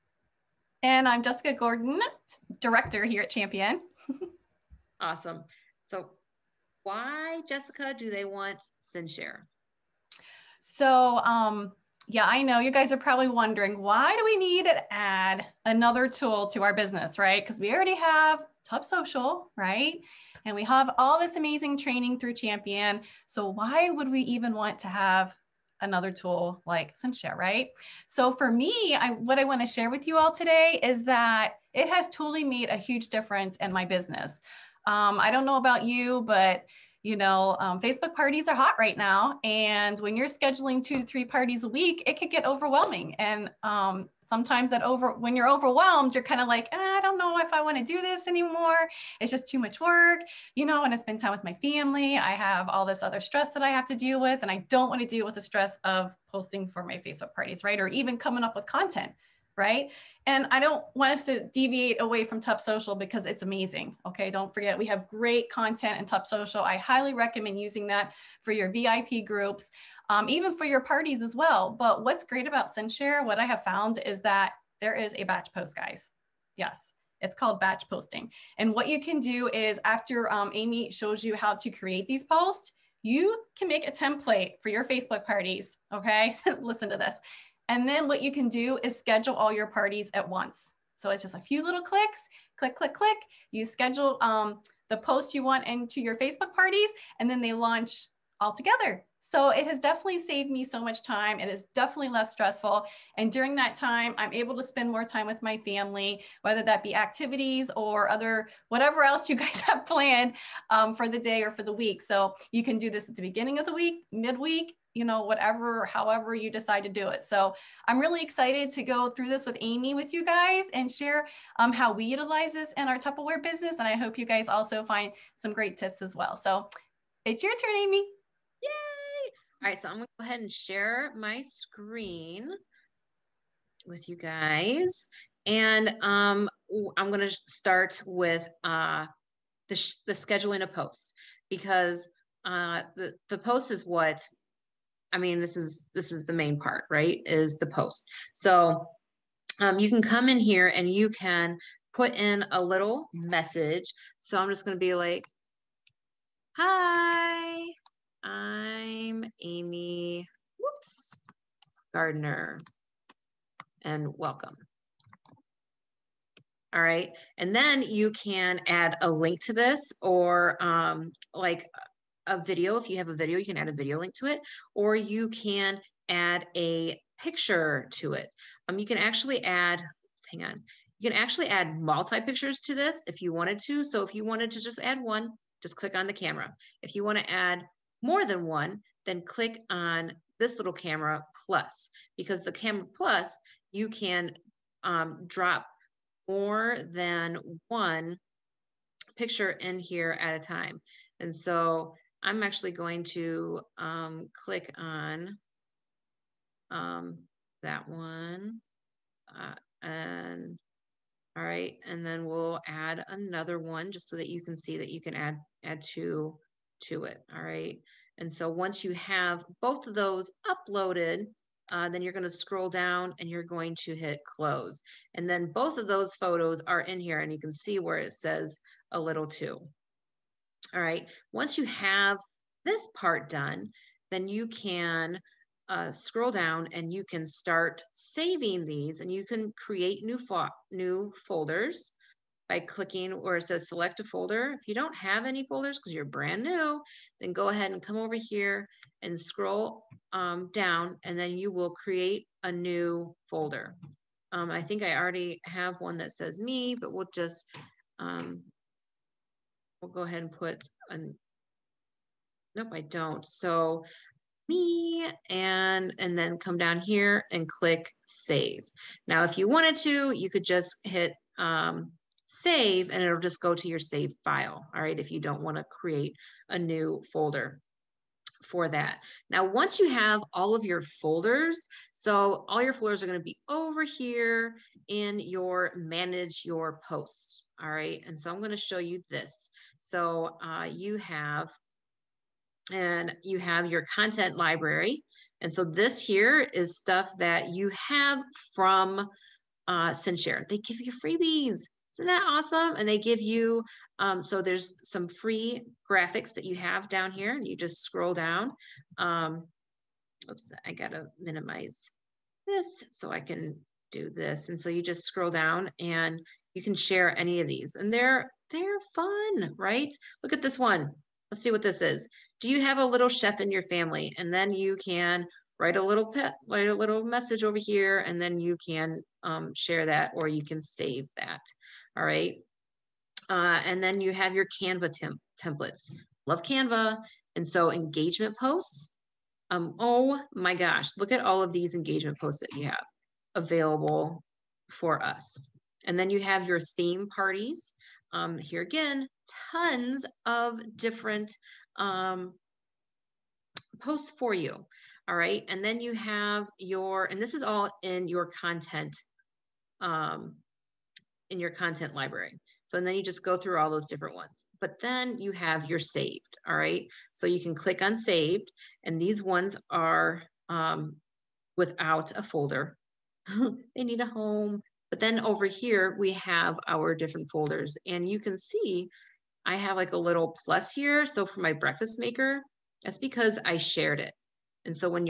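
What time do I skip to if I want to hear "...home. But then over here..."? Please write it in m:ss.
6:14.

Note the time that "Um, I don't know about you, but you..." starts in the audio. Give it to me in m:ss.
0:34.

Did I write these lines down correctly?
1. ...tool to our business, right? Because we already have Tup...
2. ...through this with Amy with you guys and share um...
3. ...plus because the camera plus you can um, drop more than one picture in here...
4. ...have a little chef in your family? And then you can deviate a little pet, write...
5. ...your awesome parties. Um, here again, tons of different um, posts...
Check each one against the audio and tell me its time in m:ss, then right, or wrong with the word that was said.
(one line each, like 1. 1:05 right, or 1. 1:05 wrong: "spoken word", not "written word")
1. 0:16 right
2. 1:59 right
3. 3:11 right
4. 5:22 wrong: "write", not "deviate"
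5. 5:46 wrong: "theme", not "awesome".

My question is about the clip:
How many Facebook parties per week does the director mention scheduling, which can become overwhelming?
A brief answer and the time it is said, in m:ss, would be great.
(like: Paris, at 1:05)
2 to 3, at 0:40.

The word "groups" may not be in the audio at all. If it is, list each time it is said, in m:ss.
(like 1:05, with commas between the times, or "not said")
1:09.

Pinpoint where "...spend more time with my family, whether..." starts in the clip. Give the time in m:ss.
1:44.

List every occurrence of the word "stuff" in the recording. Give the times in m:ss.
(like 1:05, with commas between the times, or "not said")
4:56.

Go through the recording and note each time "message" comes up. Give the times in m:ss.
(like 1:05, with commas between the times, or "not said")
2:33, 5:27.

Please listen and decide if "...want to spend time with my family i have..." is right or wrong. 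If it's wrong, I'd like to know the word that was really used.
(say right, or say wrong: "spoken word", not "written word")
right.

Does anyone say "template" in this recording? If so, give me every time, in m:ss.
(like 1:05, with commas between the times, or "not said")
1:23, 5:35.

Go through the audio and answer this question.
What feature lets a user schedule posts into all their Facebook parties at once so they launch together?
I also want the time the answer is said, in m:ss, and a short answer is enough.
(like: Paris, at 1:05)
batch posting, at 1:17.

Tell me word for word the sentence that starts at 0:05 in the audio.
So, why, Jessica, do they want CinchShare?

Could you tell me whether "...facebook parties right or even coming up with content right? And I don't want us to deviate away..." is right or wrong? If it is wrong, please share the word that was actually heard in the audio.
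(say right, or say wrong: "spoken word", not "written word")
right.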